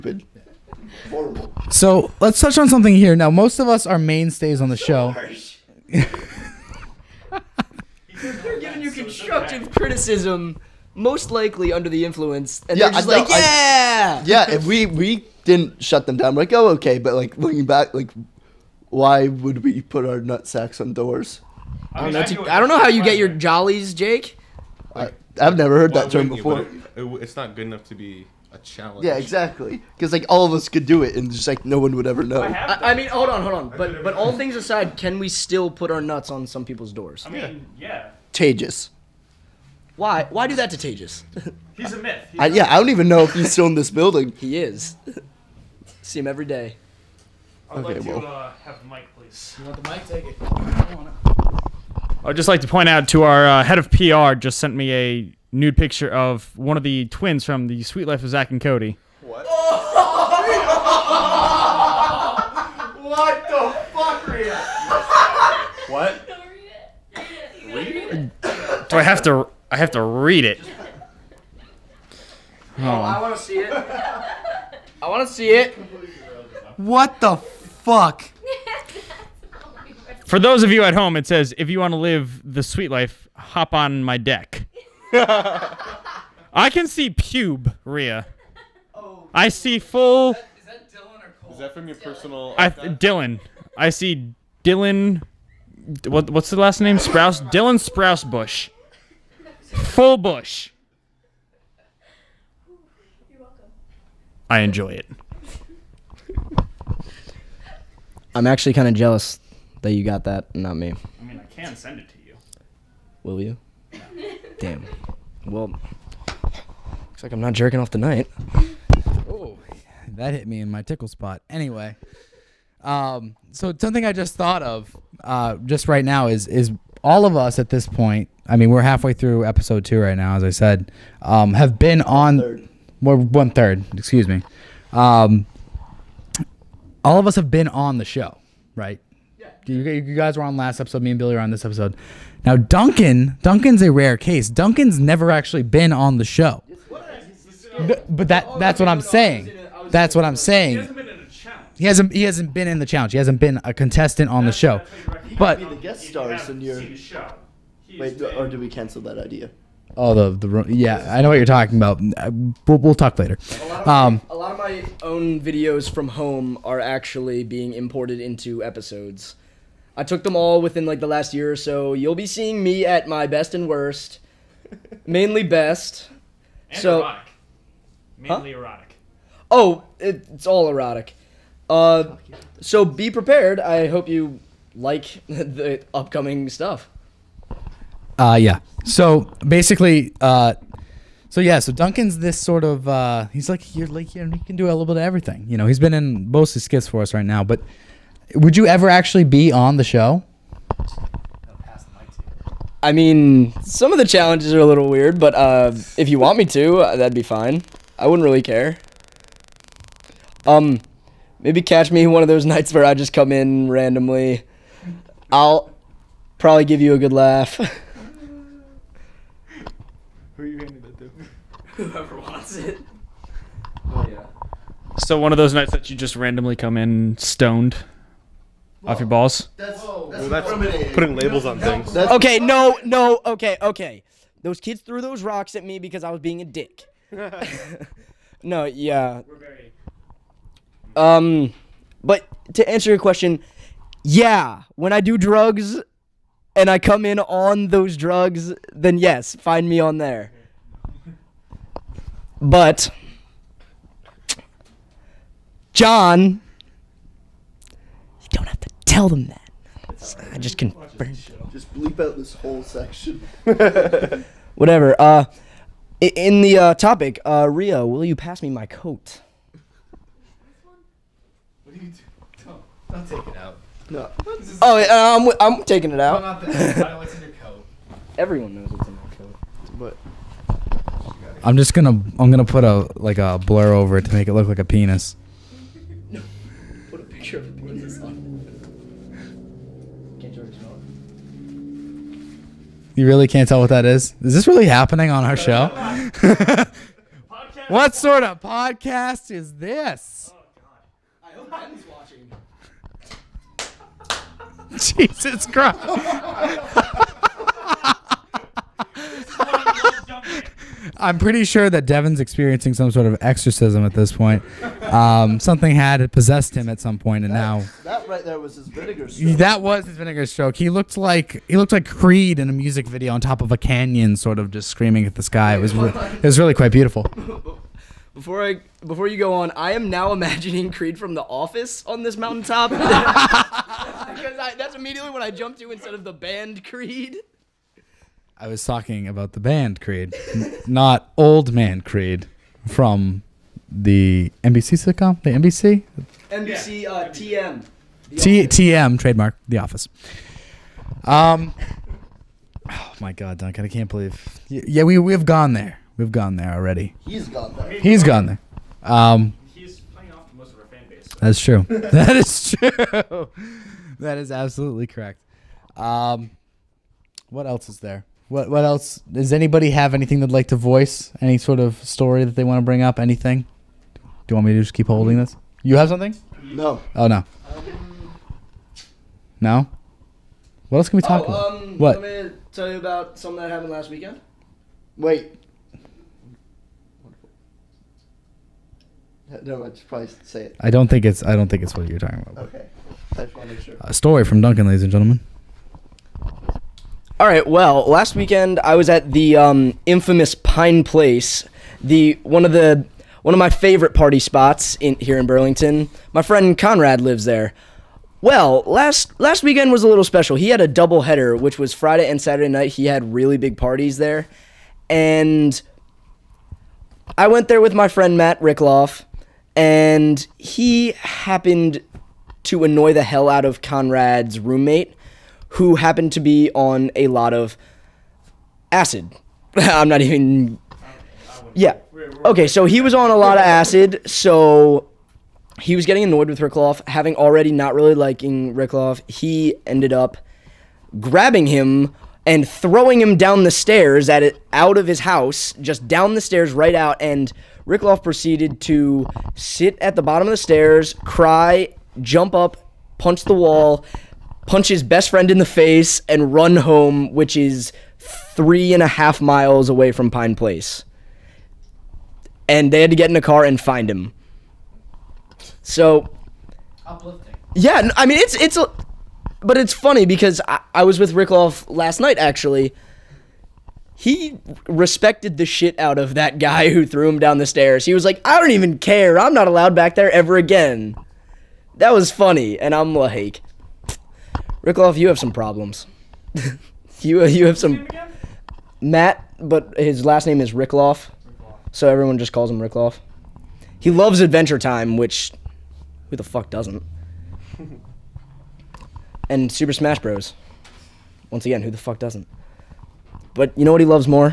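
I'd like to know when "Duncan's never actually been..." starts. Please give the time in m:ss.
2:24.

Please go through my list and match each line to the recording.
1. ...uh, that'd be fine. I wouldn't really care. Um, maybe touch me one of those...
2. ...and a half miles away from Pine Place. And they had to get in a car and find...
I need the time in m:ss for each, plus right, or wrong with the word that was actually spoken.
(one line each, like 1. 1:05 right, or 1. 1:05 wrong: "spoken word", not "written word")
1. 3:26 wrong: "catch", not "touch"
2. 7:38 right.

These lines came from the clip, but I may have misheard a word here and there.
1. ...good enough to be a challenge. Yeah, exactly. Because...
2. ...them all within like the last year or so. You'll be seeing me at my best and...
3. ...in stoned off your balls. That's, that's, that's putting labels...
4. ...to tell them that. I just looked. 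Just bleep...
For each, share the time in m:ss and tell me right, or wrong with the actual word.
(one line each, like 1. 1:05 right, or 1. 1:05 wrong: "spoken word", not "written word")
1. 0:27 right
2. 2:50 right
3. 3:46 right
4. 4:18 wrong: "confirmed", not "looked".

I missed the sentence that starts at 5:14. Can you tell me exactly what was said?
Um, something had possessed him at some point, and that, now that right there was his vinegar stroke.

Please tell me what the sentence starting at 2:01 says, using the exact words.
Anyway, um, so something I just thought of uh, just right now is is all of us at this point.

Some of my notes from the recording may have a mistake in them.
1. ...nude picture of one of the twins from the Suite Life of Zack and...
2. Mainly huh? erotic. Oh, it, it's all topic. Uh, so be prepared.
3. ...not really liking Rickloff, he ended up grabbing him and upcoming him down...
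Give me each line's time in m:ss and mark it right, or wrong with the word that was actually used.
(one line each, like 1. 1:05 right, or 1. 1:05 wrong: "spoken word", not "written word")
1. 0:55 right
2. 2:58 wrong: "erotic", not "topic"
3. 7:17 wrong: "throwing", not "upcoming".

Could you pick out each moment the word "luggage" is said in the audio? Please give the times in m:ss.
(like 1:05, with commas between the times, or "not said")
not said.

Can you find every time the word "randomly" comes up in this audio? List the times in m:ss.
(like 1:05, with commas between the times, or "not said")
3:33, 3:46.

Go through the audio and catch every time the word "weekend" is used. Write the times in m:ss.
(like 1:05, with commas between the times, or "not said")
6:23, 6:38, 6:49.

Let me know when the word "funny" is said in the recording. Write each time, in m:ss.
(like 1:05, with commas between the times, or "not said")
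7:49, 8:02.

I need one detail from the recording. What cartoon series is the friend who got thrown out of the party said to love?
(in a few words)
Adventure Time.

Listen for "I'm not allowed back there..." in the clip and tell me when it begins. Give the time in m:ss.
7:59.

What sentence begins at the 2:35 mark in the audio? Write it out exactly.
But the guest stars in your show.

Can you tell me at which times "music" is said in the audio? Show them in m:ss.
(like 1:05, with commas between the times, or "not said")
5:22.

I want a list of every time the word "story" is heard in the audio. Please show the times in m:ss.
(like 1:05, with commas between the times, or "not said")
6:11, 6:33.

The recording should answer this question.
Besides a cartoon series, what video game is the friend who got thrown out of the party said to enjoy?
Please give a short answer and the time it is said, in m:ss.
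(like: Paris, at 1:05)
Super Smash Bros., at 8:19.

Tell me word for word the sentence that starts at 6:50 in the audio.
He had a double header, which was Friday and Saturday night.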